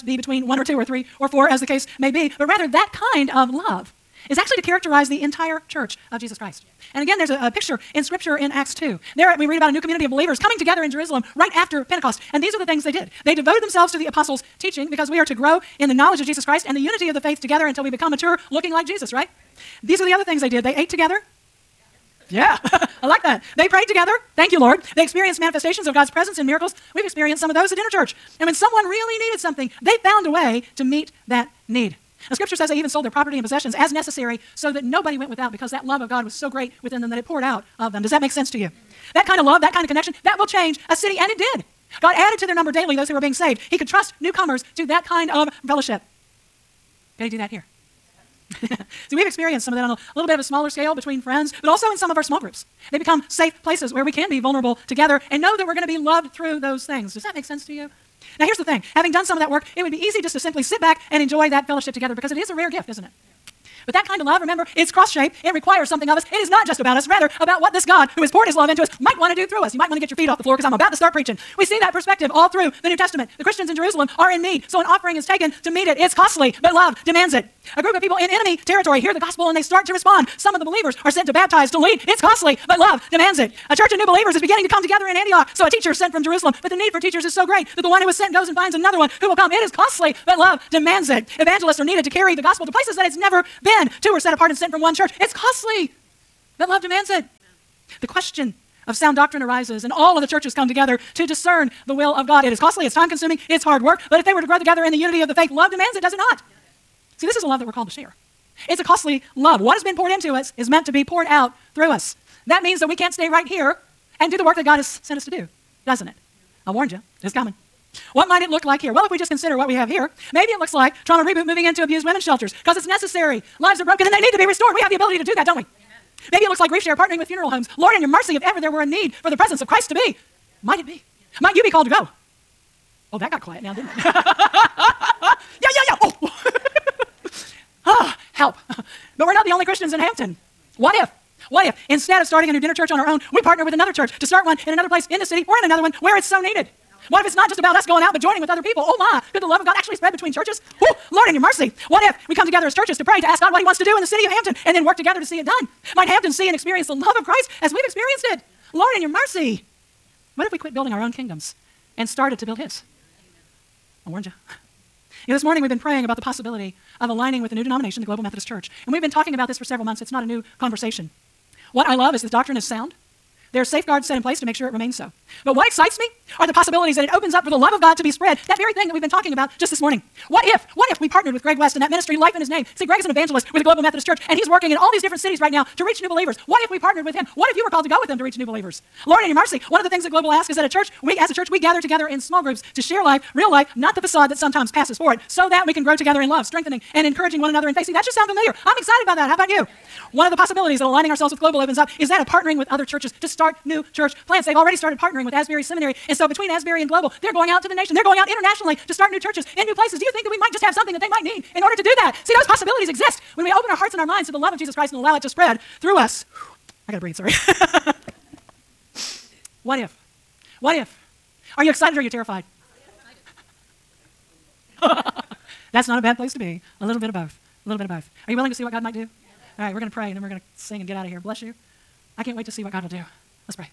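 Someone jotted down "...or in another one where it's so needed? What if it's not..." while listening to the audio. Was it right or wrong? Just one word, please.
right.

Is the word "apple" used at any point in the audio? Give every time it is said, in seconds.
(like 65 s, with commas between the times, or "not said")
not said.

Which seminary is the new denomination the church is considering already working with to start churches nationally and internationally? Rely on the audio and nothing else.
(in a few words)
Asbury Seminary.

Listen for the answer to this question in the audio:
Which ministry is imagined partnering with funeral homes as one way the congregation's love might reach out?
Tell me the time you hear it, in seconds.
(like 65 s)
126 s.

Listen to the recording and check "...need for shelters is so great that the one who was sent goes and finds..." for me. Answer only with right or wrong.
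wrong.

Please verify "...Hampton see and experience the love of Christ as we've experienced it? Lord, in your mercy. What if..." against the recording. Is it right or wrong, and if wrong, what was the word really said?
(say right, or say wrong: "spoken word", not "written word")
right.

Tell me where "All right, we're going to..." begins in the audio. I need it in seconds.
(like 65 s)
229 s.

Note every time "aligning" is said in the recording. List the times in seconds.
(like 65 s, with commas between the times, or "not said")
167 s, 200 s.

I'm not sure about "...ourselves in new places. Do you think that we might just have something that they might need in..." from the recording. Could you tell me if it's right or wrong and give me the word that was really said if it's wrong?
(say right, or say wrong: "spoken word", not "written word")
wrong: "churches", not "ourselves".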